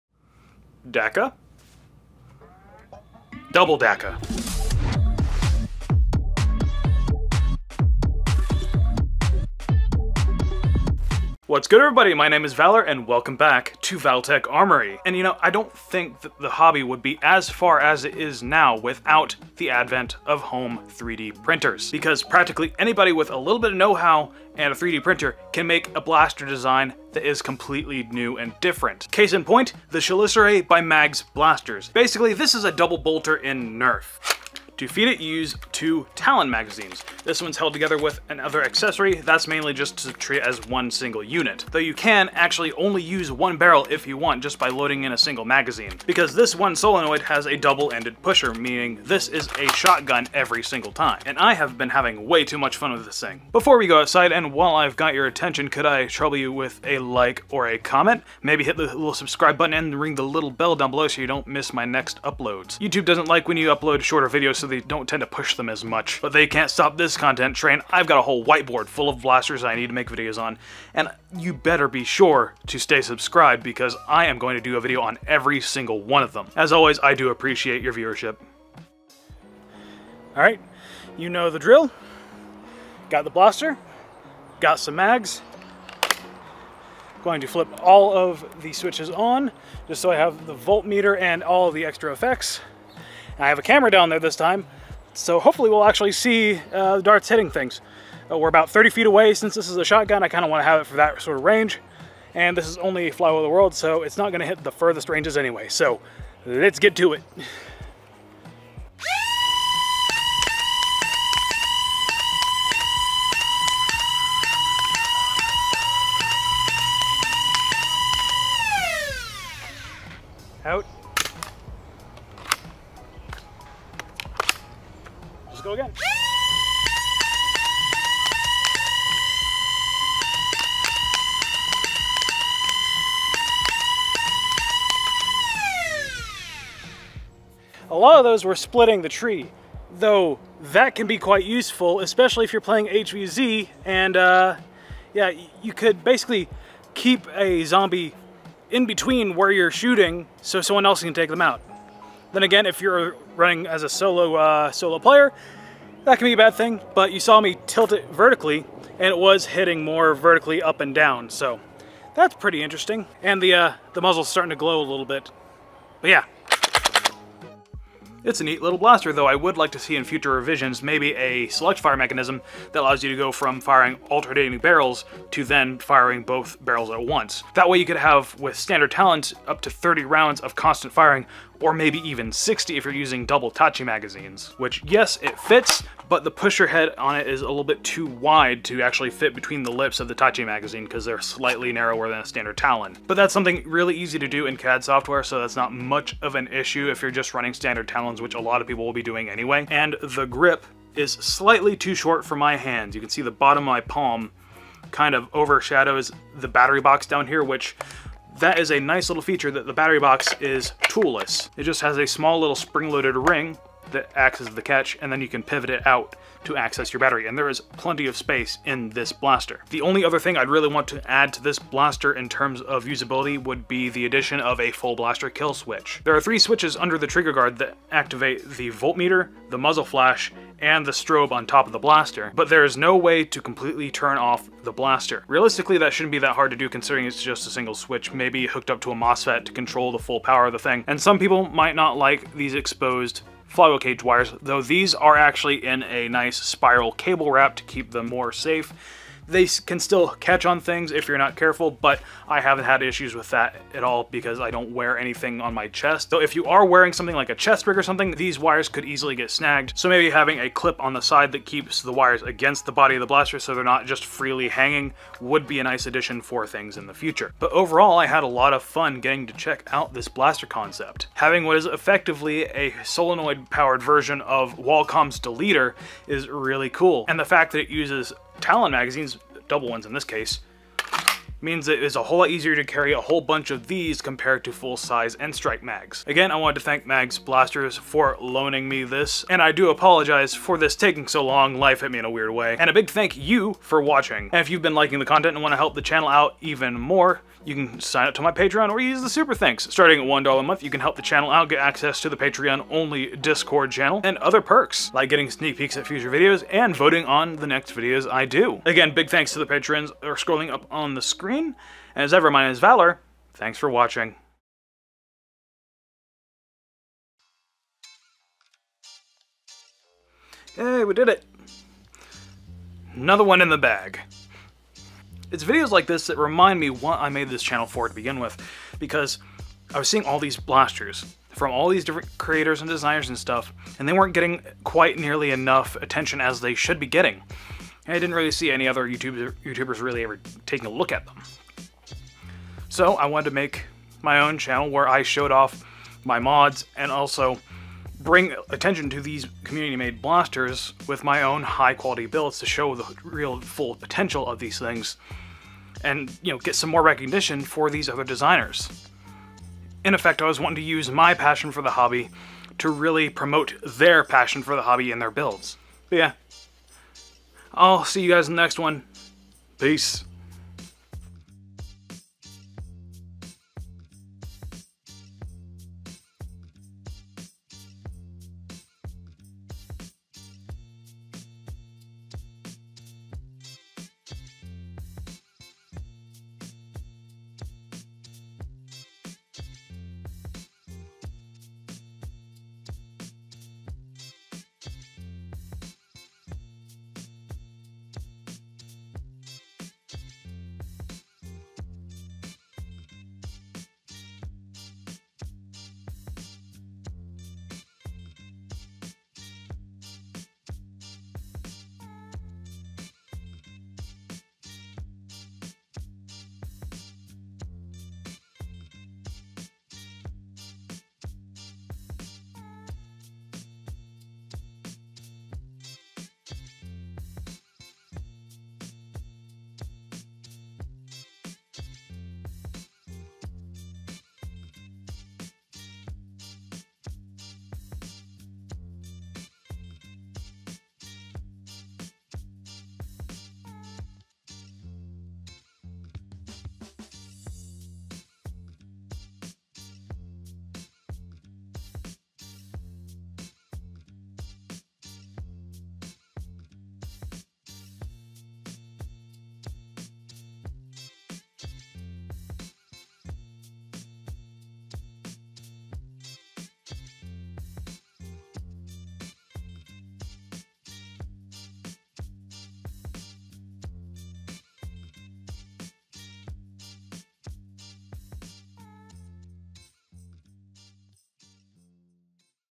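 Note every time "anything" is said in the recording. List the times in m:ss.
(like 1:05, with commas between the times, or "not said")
4:14.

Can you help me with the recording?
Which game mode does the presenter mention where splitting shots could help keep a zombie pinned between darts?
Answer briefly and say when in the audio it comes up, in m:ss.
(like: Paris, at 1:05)
HVZ, at 2:22.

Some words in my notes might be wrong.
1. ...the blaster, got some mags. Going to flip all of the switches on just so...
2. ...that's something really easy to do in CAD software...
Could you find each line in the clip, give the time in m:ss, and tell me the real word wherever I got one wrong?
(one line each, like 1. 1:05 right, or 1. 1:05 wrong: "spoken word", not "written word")
1. 1:23 right
2. 3:13 right.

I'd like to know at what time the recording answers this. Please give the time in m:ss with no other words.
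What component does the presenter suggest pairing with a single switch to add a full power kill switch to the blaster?
3:58.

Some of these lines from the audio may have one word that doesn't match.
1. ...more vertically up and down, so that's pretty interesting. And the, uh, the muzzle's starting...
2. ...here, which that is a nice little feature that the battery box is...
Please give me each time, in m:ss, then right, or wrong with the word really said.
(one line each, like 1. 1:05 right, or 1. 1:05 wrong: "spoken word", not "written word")
1. 2:39 right
2. 3:27 right.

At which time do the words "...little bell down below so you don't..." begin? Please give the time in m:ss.
1:00.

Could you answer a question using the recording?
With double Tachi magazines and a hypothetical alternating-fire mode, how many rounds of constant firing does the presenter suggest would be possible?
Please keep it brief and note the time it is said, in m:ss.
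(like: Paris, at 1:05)
60, at 3:02.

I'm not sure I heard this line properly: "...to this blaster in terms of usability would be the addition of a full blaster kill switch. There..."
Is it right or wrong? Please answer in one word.
right.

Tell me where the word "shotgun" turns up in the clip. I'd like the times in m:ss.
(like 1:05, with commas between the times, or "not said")
0:49, 1:39.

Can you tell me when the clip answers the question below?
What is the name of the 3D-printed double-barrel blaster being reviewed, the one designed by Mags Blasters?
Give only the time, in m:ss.
0:29.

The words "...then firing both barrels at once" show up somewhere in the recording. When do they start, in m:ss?
2:55.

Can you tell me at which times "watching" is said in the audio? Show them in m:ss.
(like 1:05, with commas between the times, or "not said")
4:53, 5:13.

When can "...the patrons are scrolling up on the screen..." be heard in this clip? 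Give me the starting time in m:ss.
5:09.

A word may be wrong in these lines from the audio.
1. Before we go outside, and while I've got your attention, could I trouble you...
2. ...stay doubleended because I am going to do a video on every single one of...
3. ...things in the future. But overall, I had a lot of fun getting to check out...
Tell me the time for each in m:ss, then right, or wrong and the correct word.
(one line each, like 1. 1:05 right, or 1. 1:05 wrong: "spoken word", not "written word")
1. 0:53 right
2. 1:12 wrong: "subscribed", not "doubleended"
3. 4:26 right.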